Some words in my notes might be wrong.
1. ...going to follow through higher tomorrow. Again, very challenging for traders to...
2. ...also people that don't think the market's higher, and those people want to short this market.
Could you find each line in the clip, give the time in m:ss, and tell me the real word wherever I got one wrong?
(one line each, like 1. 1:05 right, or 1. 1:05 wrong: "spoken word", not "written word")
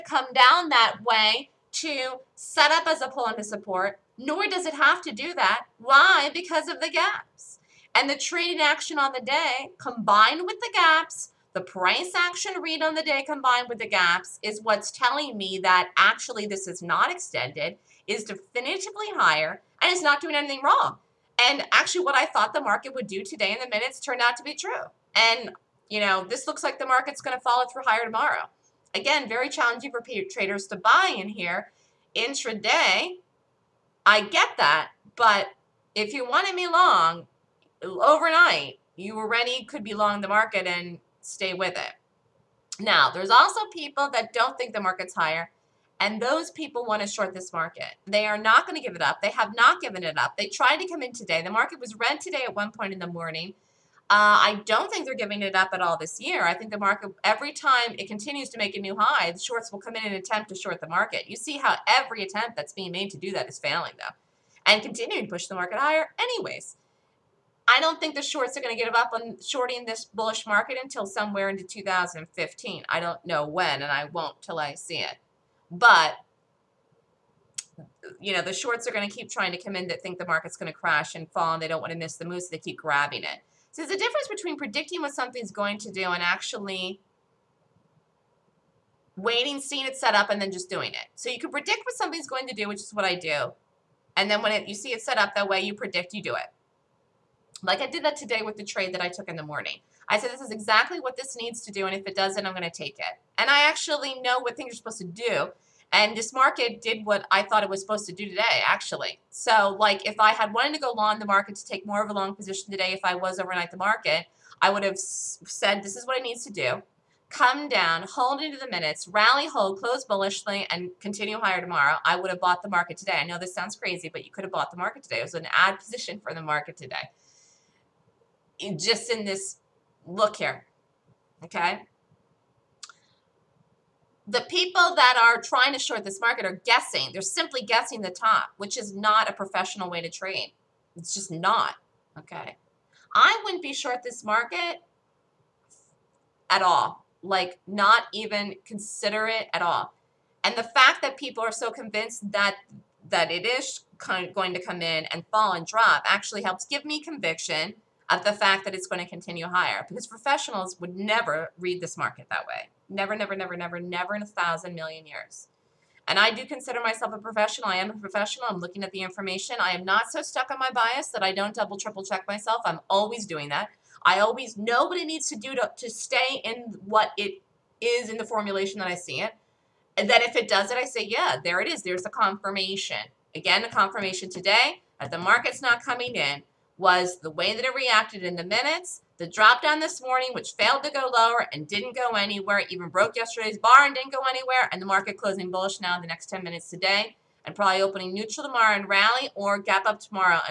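1. 0:27 right
2. 0:43 right.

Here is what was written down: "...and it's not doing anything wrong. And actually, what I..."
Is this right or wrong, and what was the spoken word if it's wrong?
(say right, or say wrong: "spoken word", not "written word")
right.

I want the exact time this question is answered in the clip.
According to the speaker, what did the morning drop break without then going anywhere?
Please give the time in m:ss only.
3:13.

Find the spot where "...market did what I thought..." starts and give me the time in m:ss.
1:46.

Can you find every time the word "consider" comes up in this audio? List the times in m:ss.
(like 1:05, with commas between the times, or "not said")
2:28, 2:46.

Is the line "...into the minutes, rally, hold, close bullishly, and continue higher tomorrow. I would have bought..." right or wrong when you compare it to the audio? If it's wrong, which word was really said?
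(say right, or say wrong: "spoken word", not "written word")
right.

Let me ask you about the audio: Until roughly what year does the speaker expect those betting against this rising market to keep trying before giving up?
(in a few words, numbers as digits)
2015.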